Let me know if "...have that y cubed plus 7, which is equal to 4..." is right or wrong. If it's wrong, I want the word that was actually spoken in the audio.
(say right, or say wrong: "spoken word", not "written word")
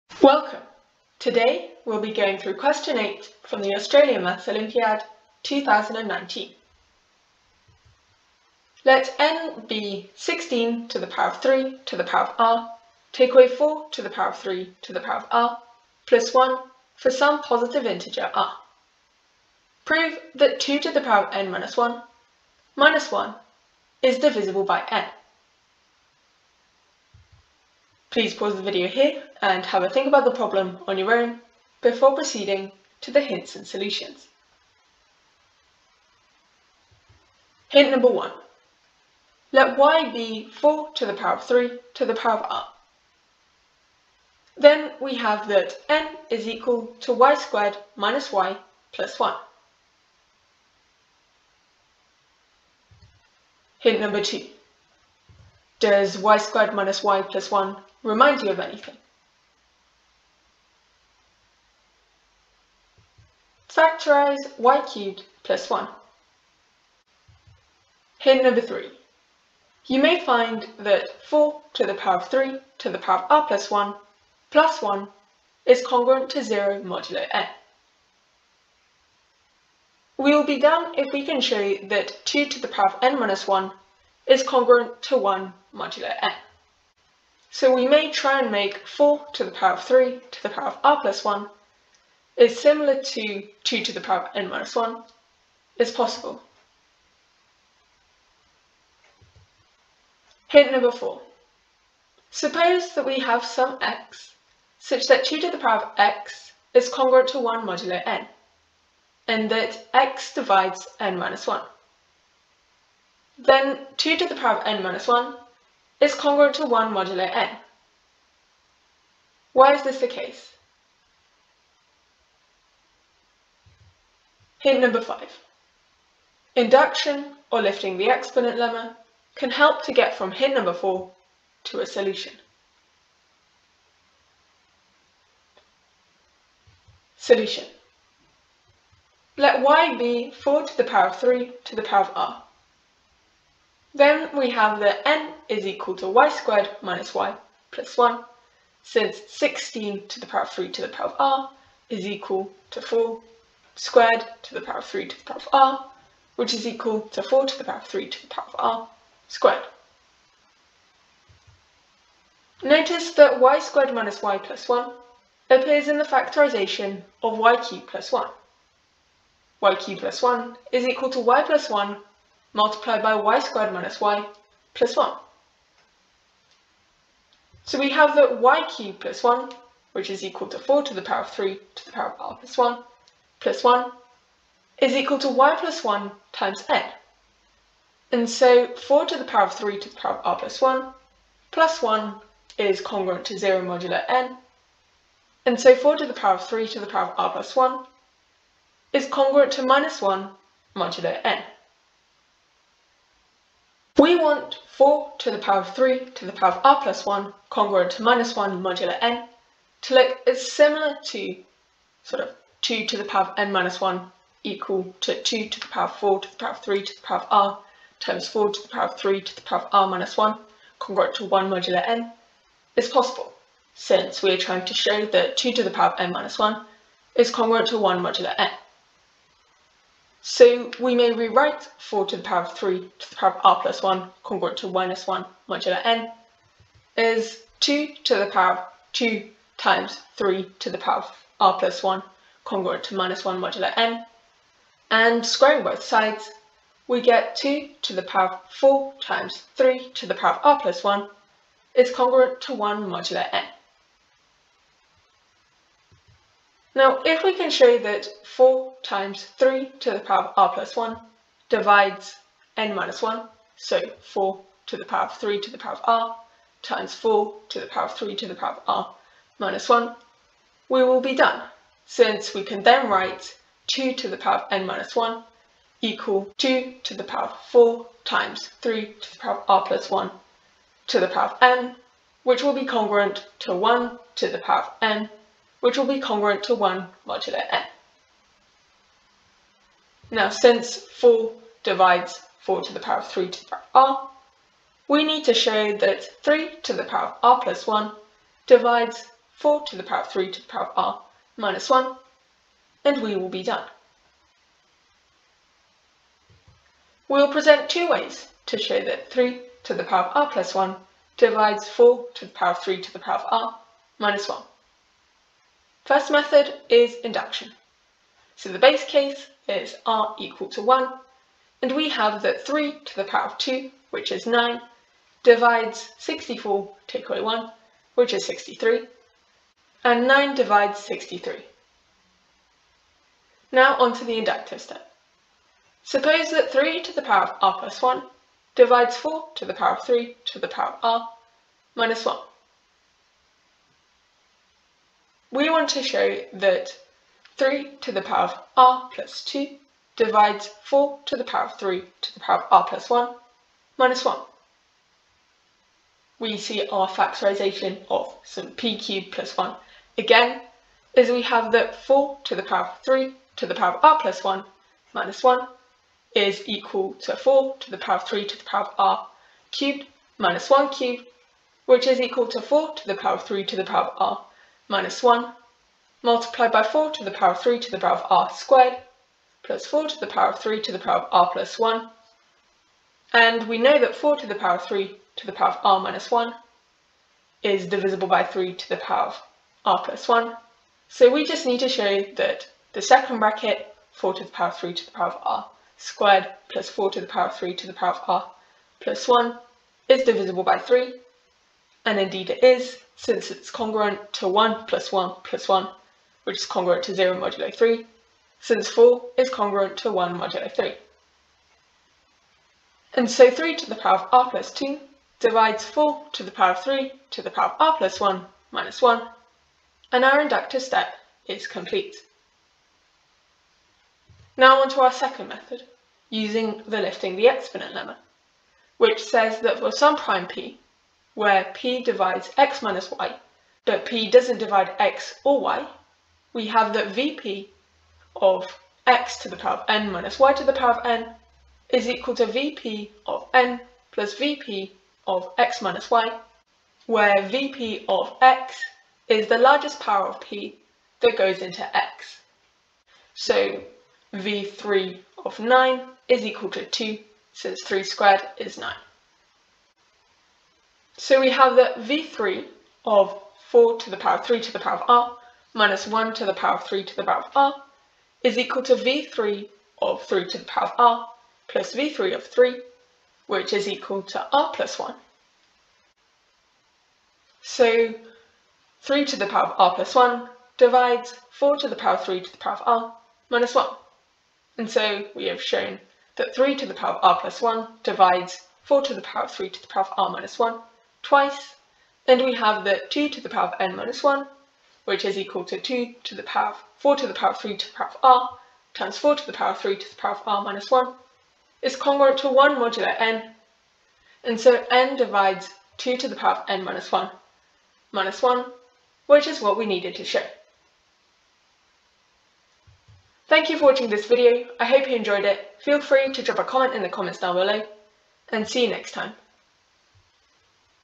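wrong: "1", not "7".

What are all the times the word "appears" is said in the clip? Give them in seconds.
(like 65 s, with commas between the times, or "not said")
165 s.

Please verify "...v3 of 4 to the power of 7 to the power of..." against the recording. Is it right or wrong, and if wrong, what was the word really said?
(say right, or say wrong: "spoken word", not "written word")
wrong: "3", not "7".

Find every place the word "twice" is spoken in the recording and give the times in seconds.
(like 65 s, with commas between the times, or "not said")
491 s.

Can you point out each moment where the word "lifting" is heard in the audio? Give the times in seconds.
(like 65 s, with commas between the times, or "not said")
127 s, 426 s.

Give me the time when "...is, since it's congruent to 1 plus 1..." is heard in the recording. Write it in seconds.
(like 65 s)
402 s.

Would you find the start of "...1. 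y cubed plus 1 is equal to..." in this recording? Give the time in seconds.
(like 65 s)
168 s.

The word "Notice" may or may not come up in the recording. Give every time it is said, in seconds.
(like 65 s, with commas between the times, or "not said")
162 s.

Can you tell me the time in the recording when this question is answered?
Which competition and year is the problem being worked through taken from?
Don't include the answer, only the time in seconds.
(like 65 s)
3 s.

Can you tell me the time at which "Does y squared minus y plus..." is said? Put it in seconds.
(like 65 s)
55 s.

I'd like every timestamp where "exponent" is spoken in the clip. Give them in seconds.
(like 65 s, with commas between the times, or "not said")
128 s, 427 s.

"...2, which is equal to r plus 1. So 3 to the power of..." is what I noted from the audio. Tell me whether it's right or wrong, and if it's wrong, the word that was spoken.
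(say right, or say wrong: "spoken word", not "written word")
wrong: "3", not "2".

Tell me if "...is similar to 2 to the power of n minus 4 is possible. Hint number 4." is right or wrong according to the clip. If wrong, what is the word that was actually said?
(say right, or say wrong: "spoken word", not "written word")
wrong: "1", not "4".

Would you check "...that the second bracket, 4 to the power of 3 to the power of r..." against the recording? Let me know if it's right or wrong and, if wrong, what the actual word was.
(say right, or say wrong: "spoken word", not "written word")
right.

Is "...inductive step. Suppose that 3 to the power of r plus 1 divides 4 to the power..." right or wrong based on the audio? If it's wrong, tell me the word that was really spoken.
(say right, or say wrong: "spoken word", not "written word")
right.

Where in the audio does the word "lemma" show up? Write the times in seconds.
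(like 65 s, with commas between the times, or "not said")
128 s, 427 s.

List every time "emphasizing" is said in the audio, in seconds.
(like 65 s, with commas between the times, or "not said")
not said.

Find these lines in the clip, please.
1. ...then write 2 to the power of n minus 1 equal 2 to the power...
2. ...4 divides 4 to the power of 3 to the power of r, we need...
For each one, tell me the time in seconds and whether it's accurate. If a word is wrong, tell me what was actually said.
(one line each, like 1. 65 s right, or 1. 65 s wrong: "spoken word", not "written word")
1. 272 s right
2. 290 s right.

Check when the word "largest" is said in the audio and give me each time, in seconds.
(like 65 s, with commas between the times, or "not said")
449 s.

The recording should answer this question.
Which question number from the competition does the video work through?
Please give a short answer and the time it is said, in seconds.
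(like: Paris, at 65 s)
8, at 2 s.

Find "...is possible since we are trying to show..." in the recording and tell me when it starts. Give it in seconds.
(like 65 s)
222 s.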